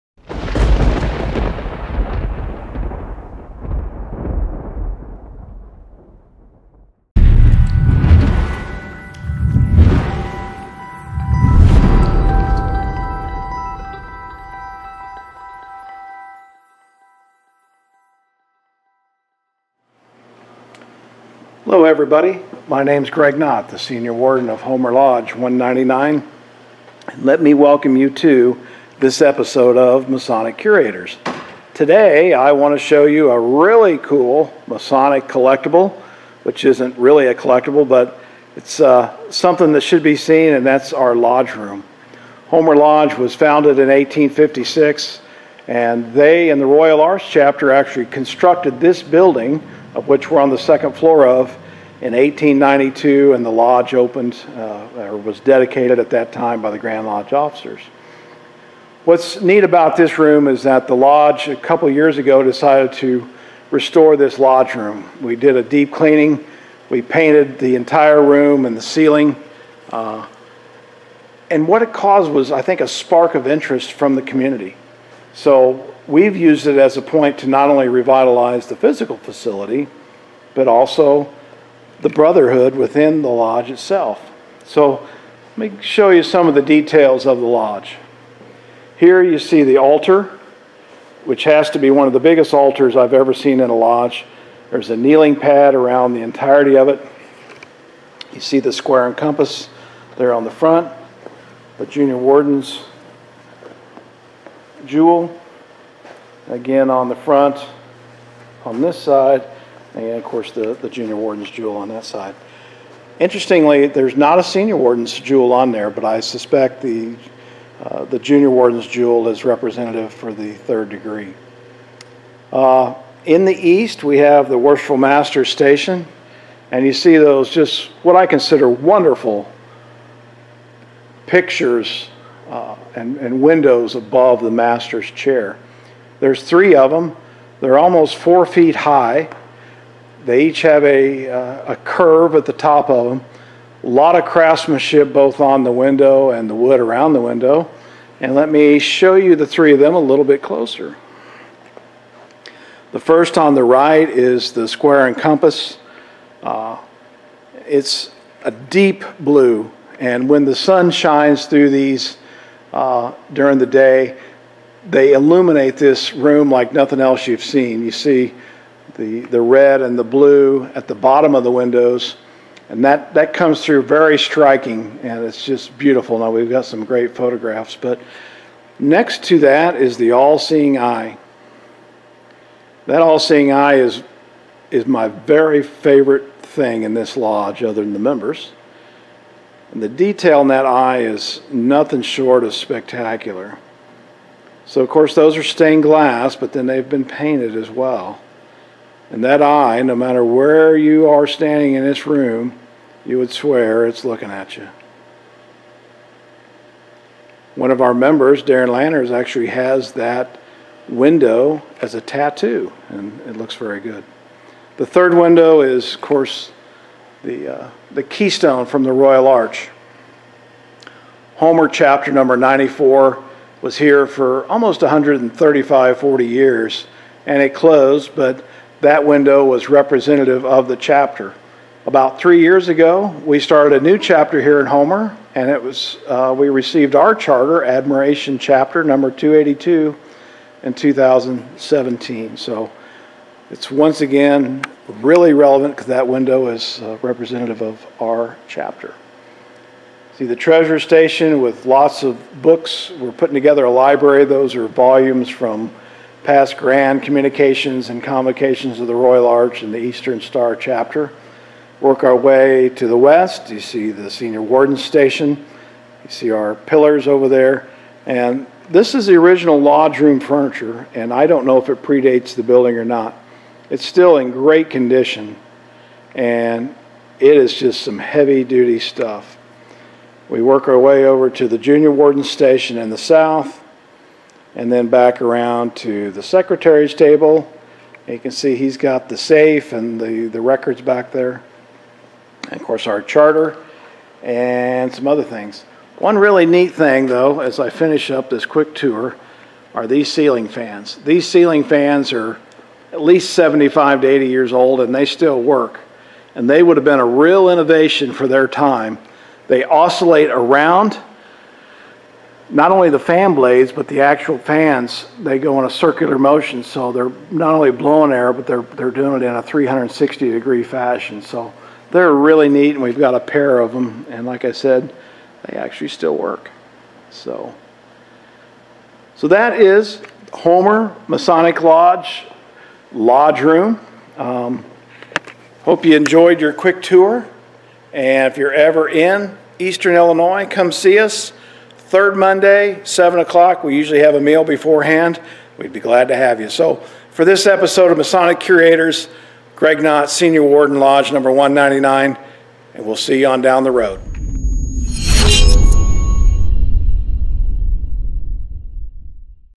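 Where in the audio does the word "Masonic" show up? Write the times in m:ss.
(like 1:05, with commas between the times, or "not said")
0:30, 0:34, 5:31, 5:47.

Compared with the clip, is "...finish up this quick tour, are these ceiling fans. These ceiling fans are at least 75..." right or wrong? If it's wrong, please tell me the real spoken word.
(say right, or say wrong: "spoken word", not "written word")
right.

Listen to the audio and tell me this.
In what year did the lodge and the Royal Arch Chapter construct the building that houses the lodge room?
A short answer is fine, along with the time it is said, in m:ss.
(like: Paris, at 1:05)
1892, at 0:52.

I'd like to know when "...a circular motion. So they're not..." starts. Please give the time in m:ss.
5:15.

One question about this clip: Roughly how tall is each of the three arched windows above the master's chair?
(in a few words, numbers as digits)
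4 feet.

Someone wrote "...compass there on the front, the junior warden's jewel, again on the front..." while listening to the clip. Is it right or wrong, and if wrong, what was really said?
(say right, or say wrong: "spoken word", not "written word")
right.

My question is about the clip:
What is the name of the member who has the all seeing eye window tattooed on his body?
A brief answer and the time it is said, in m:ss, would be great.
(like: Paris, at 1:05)
Darren Lanners, at 3:28.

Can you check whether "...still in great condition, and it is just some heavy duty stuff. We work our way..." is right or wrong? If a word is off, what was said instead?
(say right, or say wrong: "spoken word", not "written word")
right.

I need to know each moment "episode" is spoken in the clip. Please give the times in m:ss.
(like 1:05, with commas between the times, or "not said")
0:29, 5:47.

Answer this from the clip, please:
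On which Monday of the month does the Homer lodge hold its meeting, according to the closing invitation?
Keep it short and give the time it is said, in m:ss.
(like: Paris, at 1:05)
Third Monday, at 5:41.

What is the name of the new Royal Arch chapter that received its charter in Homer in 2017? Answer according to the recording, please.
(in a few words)
Admiration Chapter.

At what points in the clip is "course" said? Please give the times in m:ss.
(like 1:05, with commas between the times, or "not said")
1:50, 3:14, 3:36, 4:52.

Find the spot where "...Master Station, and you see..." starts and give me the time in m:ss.
2:04.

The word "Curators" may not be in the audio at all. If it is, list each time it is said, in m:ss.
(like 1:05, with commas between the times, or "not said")
0:30, 5:48.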